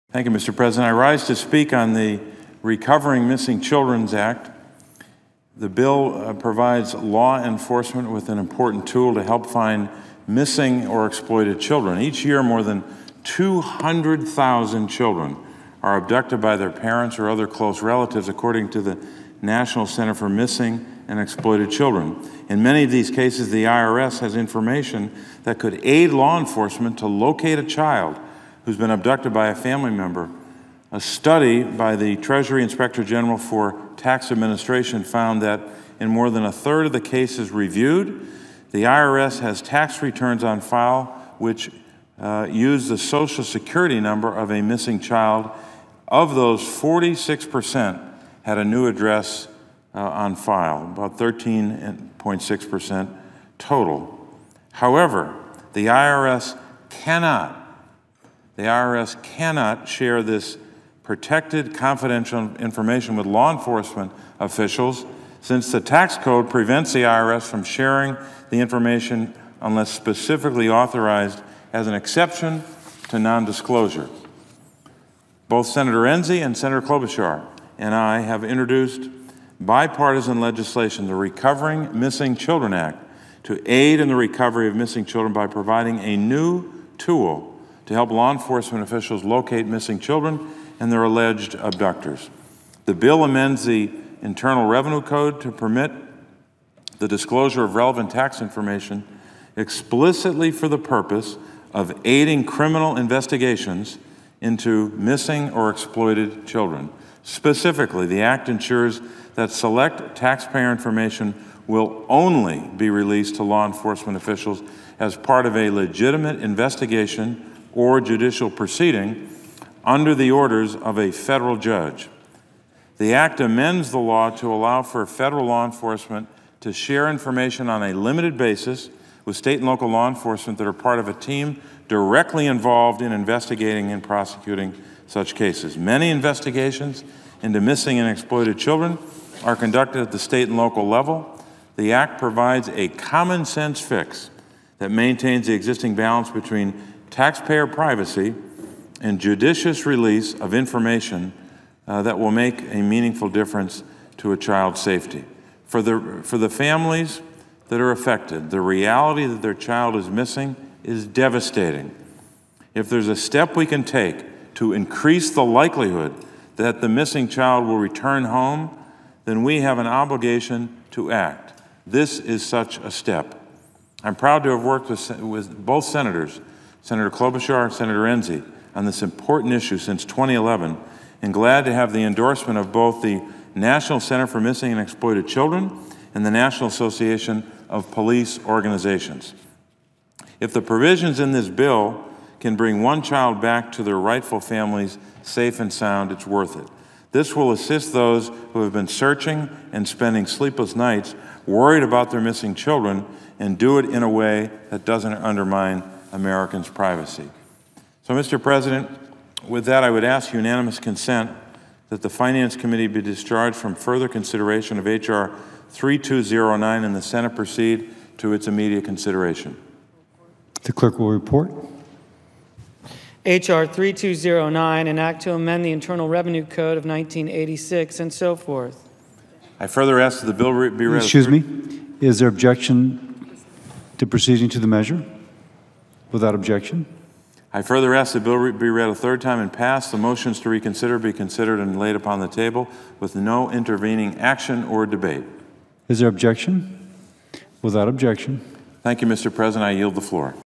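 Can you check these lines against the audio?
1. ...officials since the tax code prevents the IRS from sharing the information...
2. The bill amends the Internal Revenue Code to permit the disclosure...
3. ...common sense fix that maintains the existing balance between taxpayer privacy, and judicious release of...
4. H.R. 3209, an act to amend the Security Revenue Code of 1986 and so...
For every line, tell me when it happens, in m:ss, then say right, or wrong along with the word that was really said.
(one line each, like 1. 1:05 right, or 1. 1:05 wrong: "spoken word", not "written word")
1. 1:04 right
2. 1:32 right
3. 2:22 right
4. 3:43 wrong: "Internal", not "Security".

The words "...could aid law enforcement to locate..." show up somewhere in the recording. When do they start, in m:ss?
0:25.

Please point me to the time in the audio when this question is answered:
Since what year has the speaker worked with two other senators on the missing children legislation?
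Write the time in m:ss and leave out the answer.
3:00.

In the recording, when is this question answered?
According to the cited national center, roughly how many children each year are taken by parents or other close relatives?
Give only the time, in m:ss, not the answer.
0:13.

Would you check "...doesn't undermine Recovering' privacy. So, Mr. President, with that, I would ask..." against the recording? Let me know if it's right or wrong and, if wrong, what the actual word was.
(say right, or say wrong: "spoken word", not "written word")
wrong: "Americans", not "Recovering".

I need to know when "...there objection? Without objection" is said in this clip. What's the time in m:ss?
4:05.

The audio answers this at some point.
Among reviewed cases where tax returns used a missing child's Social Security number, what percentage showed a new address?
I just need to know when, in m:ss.
0:46.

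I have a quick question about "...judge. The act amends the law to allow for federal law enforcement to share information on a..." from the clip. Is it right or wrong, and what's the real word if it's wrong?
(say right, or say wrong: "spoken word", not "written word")
right.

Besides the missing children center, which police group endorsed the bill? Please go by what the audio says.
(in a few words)
National Association of Police Organizations.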